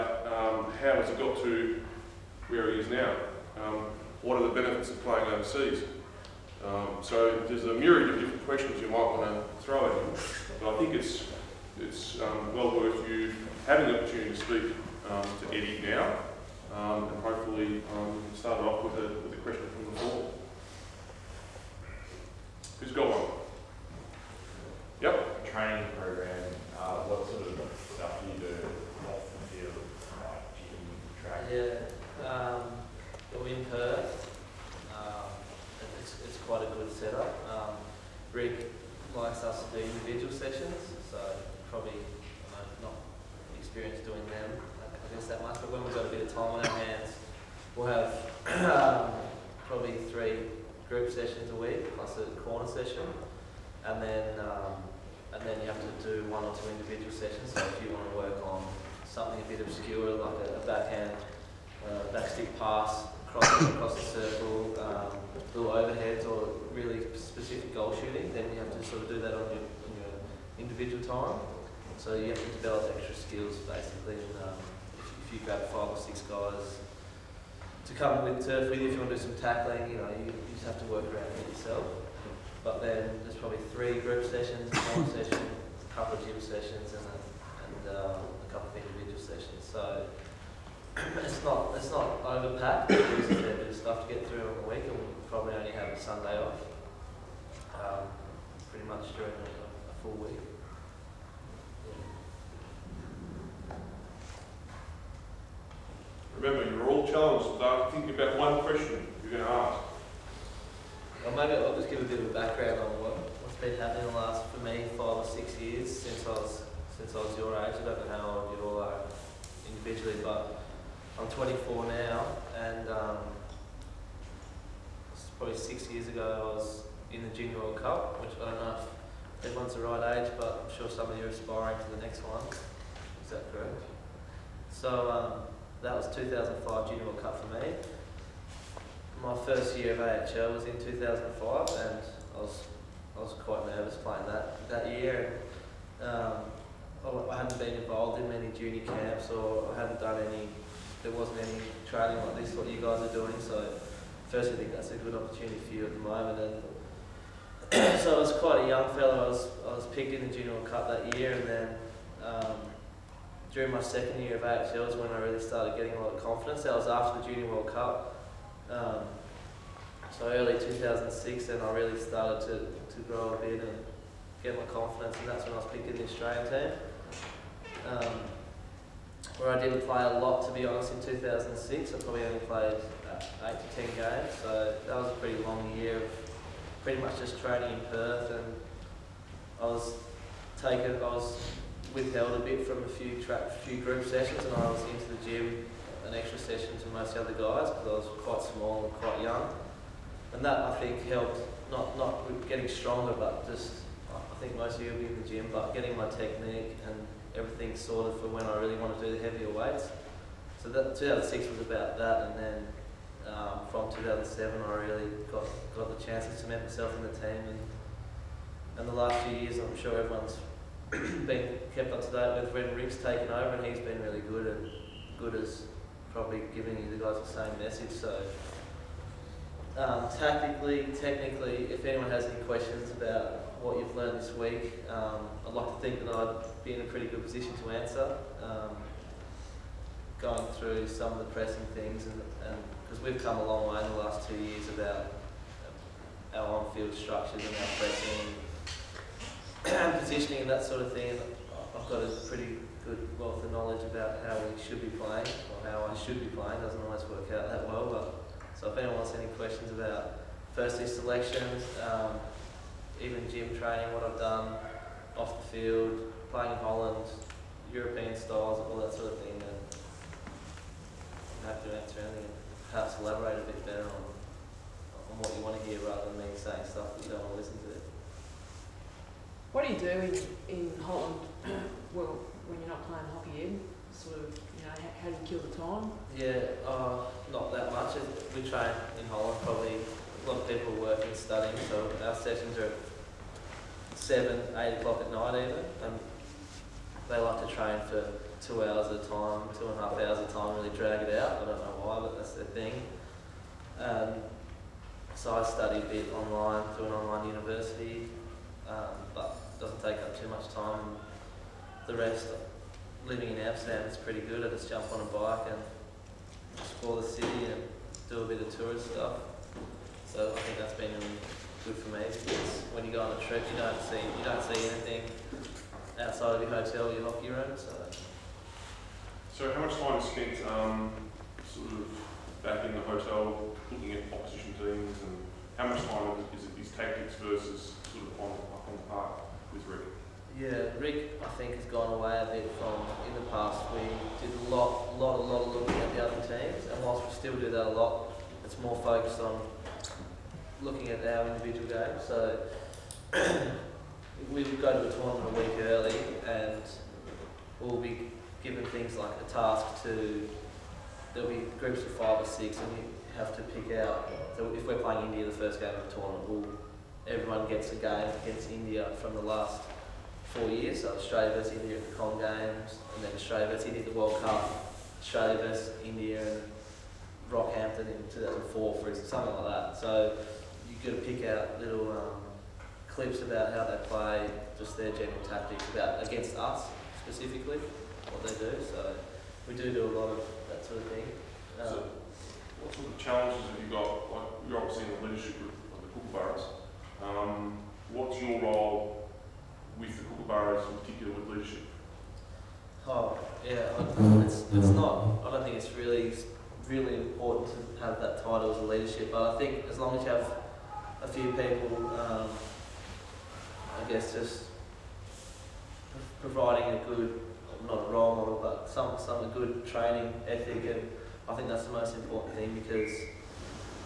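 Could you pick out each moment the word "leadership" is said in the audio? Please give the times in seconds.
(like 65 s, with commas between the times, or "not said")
395 s, 401 s, 408 s.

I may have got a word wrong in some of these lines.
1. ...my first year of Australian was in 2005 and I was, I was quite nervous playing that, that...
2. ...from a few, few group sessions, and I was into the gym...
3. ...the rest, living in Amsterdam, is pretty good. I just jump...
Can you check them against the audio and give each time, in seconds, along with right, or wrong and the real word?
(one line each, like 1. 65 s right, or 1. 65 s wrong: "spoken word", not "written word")
1. 139 s wrong: "AHL", not "Australian"
2. 192 s right
3. 311 s right.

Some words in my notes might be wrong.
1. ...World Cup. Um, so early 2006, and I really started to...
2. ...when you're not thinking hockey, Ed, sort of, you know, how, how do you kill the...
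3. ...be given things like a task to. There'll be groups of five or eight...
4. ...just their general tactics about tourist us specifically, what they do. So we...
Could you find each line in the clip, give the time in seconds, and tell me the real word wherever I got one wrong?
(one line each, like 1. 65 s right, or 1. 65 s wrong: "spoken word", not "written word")
1. 167 s right
2. 282 s wrong: "playing", not "thinking"
3. 357 s wrong: "six", not "eight"
4. 384 s wrong: "against", not "tourist".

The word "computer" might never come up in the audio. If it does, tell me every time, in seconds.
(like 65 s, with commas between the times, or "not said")
not said.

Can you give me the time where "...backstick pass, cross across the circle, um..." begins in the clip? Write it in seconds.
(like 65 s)
62 s.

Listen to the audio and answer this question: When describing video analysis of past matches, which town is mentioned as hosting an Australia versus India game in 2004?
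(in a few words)
Rockhampton.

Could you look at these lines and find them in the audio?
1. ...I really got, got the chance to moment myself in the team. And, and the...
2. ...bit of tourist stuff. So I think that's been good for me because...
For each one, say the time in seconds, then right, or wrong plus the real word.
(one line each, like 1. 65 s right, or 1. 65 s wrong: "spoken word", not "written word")
1. 214 s wrong: "cement", not "moment"
2. 318 s right.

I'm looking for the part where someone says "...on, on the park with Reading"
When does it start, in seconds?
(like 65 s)
338 s.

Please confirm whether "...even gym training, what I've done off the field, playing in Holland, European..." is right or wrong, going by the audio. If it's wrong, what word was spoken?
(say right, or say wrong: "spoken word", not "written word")
right.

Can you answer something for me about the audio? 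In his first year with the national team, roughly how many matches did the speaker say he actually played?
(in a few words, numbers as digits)
8 to 10.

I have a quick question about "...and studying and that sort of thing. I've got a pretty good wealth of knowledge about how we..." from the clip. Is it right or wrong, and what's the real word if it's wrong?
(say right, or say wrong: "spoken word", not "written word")
wrong: "positioning", not "studying".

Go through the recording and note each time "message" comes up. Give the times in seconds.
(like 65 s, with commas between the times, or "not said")
227 s.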